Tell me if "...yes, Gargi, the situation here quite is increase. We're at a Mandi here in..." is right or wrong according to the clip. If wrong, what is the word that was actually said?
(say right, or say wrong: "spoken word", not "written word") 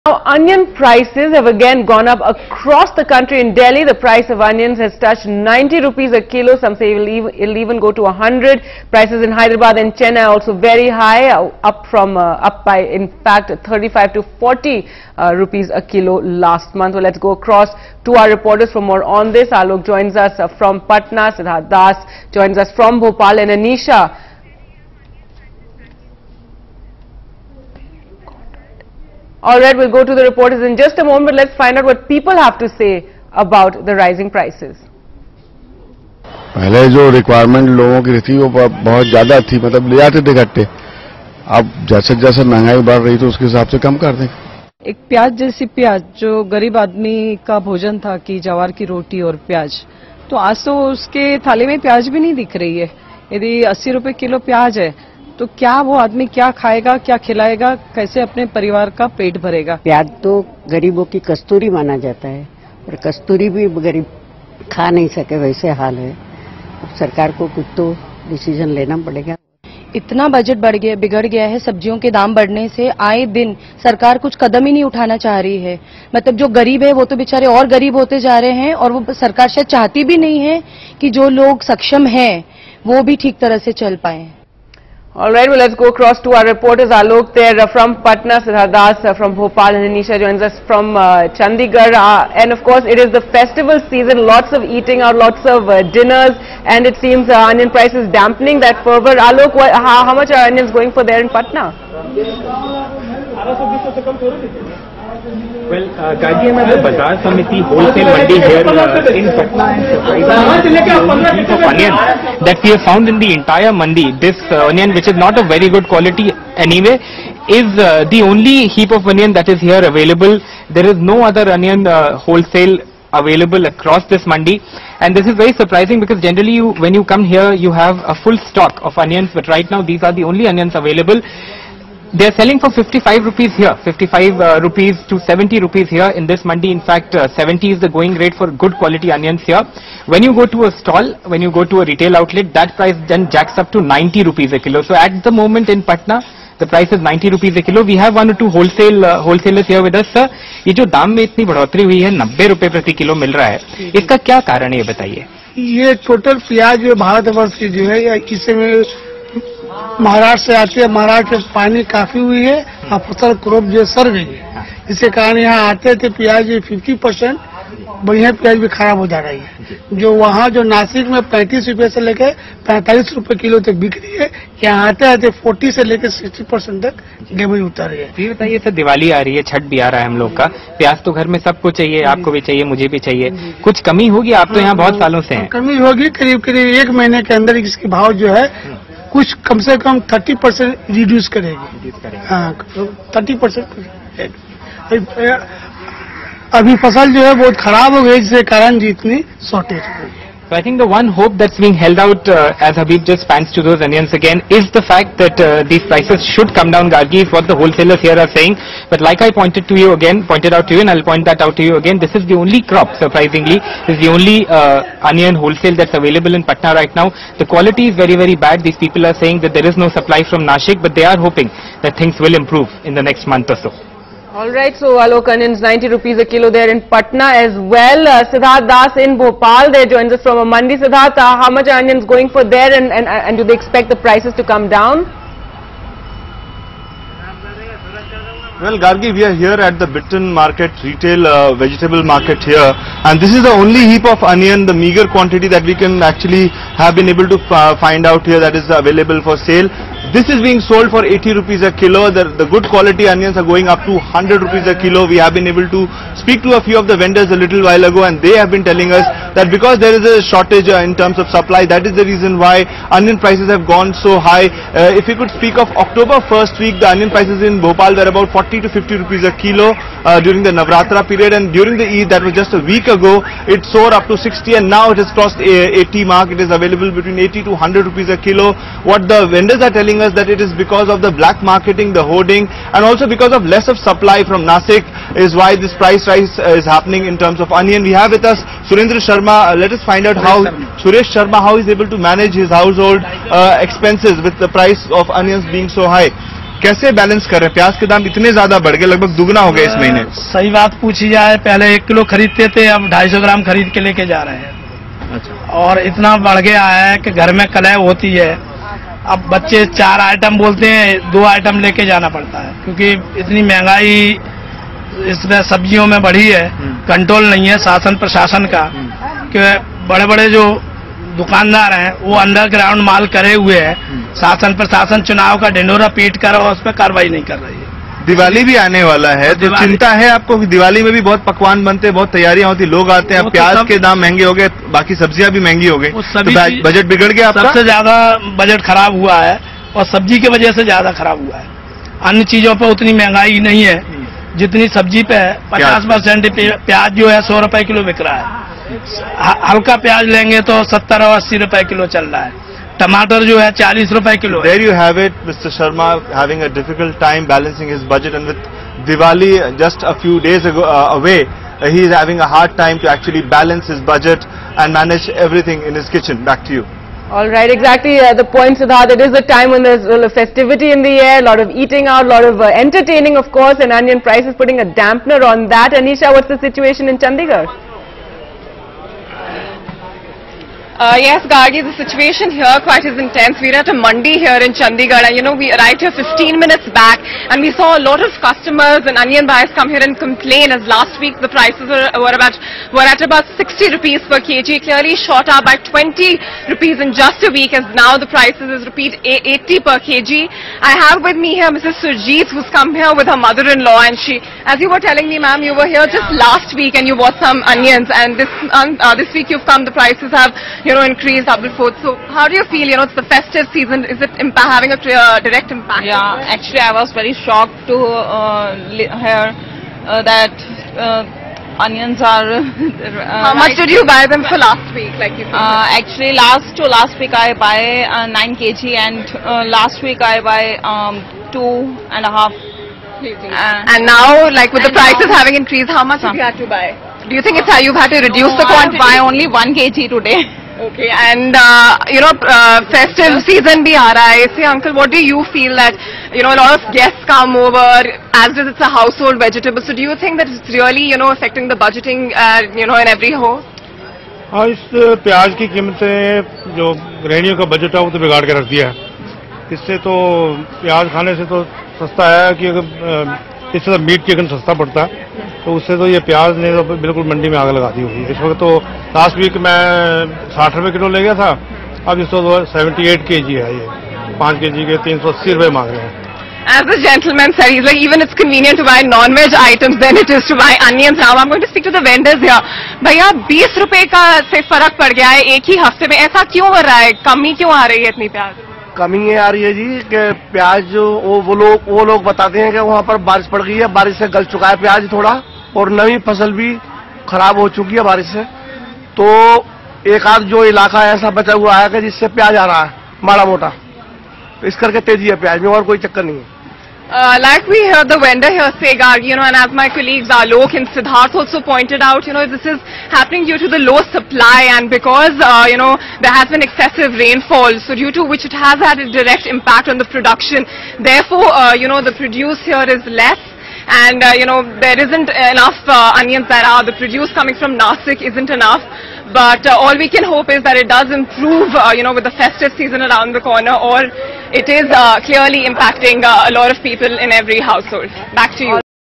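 wrong: "intense", not "increase".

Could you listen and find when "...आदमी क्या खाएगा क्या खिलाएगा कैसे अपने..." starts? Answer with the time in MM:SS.
00:55.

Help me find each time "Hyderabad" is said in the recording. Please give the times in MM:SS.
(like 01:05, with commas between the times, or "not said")
00:09.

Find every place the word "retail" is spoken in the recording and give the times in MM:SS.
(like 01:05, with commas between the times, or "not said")
02:21, 04:00.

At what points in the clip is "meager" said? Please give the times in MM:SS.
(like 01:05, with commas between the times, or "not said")
04:04.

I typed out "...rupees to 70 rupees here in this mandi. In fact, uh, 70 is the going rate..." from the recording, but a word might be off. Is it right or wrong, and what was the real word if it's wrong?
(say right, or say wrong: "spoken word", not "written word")
right.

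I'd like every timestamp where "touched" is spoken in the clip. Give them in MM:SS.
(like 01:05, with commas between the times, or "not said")
00:04.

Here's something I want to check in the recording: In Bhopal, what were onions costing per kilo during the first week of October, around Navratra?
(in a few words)
40 to 50 rupees.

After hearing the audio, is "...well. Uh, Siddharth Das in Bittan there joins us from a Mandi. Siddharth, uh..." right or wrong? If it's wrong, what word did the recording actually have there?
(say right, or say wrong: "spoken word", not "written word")
wrong: "Bhopal", not "Bittan".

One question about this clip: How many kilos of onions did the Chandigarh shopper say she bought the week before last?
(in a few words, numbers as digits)
9 kg.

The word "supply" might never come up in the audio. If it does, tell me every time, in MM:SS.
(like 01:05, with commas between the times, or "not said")
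03:39, 04:21, 04:43, 08:33.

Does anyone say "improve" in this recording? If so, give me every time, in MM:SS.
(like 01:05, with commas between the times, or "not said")
03:42, 08:50.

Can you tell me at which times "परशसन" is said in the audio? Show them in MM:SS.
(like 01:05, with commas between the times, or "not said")
05:18, 05:24.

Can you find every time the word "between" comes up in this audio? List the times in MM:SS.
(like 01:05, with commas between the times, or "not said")
04:36.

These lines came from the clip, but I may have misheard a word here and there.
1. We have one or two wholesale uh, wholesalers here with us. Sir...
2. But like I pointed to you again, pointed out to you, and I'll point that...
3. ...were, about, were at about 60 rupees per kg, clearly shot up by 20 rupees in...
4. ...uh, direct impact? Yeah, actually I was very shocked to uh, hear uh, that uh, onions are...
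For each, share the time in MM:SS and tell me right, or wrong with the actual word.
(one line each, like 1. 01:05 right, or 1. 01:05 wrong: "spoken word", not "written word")
1. 02:27 right
2. 03:28 right
3. 06:32 right
4. 06:54 right.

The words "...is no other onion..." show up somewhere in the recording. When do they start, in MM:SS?
02:00.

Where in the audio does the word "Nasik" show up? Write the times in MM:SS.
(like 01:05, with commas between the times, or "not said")
04:44, 08:47.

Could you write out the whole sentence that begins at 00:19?
Alok joins us uh, from Patna, Siddharth Das joins us from Bhopal, and Anisha.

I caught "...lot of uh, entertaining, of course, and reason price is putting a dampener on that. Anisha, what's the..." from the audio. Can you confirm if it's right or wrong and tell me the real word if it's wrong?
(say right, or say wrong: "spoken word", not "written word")
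wrong: "onion", not "reason".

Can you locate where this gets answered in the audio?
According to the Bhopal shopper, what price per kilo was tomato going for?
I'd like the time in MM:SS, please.
05:53.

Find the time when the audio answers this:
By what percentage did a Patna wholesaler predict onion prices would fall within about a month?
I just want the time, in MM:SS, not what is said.
03:10.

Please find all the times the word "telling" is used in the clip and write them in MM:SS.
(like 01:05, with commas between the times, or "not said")
04:18, 04:39, 06:44.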